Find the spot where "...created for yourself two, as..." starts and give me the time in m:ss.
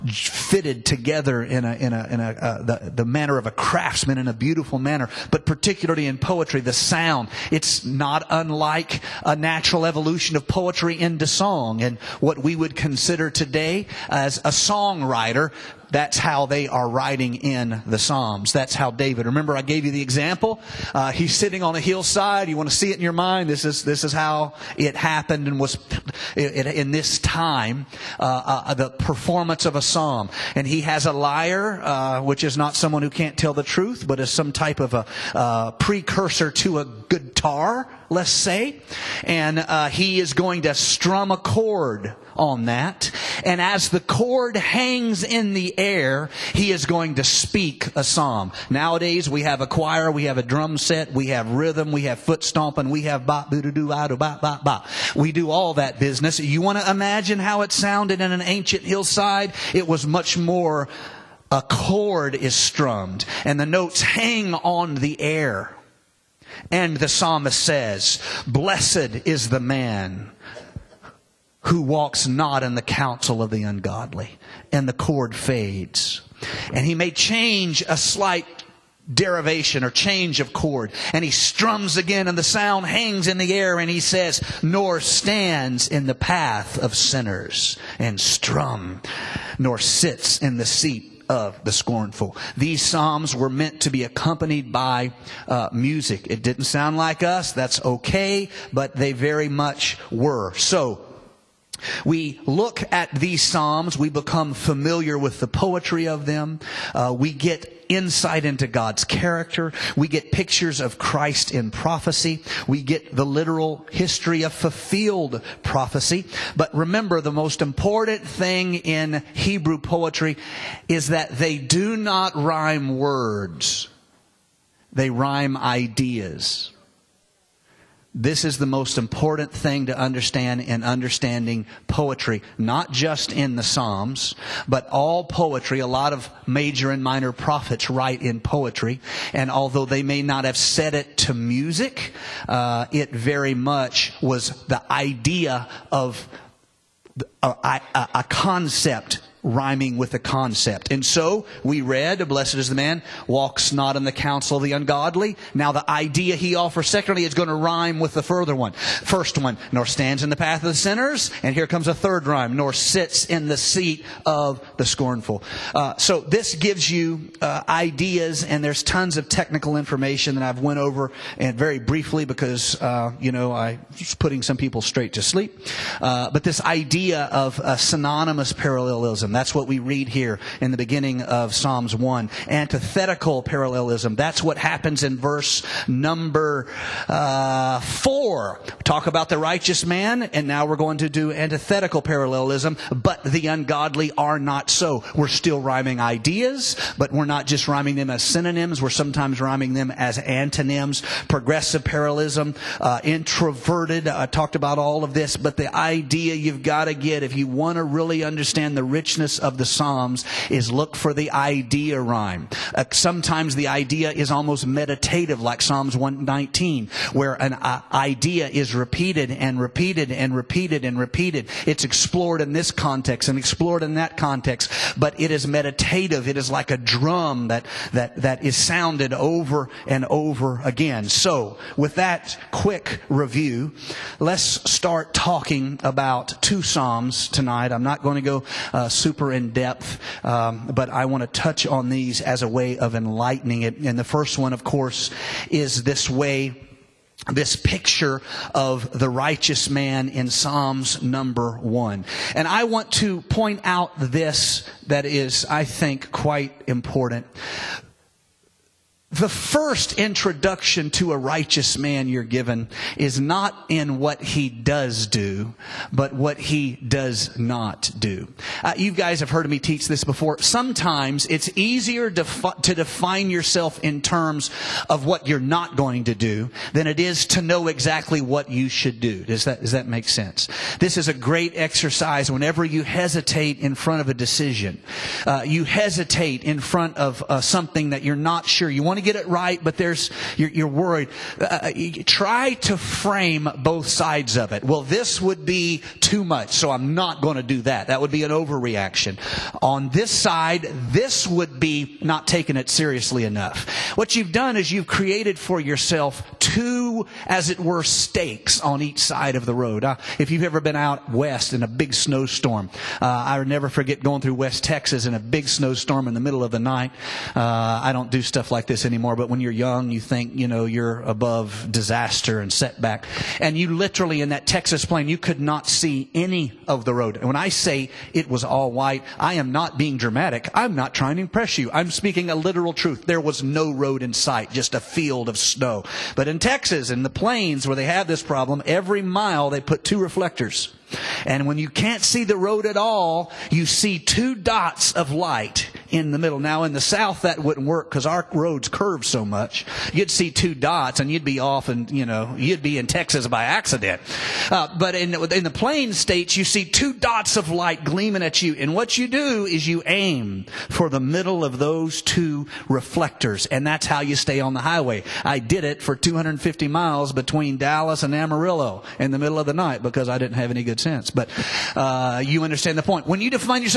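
5:04.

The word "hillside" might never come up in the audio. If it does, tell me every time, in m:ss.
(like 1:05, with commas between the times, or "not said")
0:21, 0:58.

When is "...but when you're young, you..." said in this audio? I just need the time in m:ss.
5:19.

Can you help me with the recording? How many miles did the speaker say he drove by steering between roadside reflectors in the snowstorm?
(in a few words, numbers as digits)
250.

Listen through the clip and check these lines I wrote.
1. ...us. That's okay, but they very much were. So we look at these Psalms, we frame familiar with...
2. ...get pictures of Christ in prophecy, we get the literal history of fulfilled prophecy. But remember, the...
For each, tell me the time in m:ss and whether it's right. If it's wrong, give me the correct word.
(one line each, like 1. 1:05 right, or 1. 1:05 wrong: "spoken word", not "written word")
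1. 1:37 wrong: "become", not "frame"
2. 1:50 right.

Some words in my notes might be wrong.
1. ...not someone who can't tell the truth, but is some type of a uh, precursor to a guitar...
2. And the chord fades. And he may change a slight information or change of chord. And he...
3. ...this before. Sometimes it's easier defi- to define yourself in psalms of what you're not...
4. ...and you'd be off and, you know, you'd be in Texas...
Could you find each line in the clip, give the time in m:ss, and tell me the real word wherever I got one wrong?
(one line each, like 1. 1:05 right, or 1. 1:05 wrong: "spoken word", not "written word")
1. 0:32 right
2. 1:14 wrong: "derivation", not "information"
3. 4:29 wrong: "terms", not "psalms"
4. 5:50 right.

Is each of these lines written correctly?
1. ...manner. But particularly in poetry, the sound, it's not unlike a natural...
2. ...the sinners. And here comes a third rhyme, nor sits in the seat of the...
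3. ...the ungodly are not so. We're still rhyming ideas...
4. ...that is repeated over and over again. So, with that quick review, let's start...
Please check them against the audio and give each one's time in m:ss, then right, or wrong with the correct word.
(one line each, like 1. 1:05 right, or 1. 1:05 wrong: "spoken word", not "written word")
1. 0:04 right
2. 2:40 right
3. 3:13 right
4. 3:48 wrong: "sounded", not "repeated".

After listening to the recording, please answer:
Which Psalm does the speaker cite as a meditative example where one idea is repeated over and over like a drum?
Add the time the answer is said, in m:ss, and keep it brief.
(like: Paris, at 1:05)
Psalm 119, at 3:35.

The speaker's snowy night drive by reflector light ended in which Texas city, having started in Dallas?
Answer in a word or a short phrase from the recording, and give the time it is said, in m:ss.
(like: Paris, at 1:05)
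Amarillo, at 6:08.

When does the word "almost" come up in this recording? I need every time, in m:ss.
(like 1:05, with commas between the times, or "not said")
3:34.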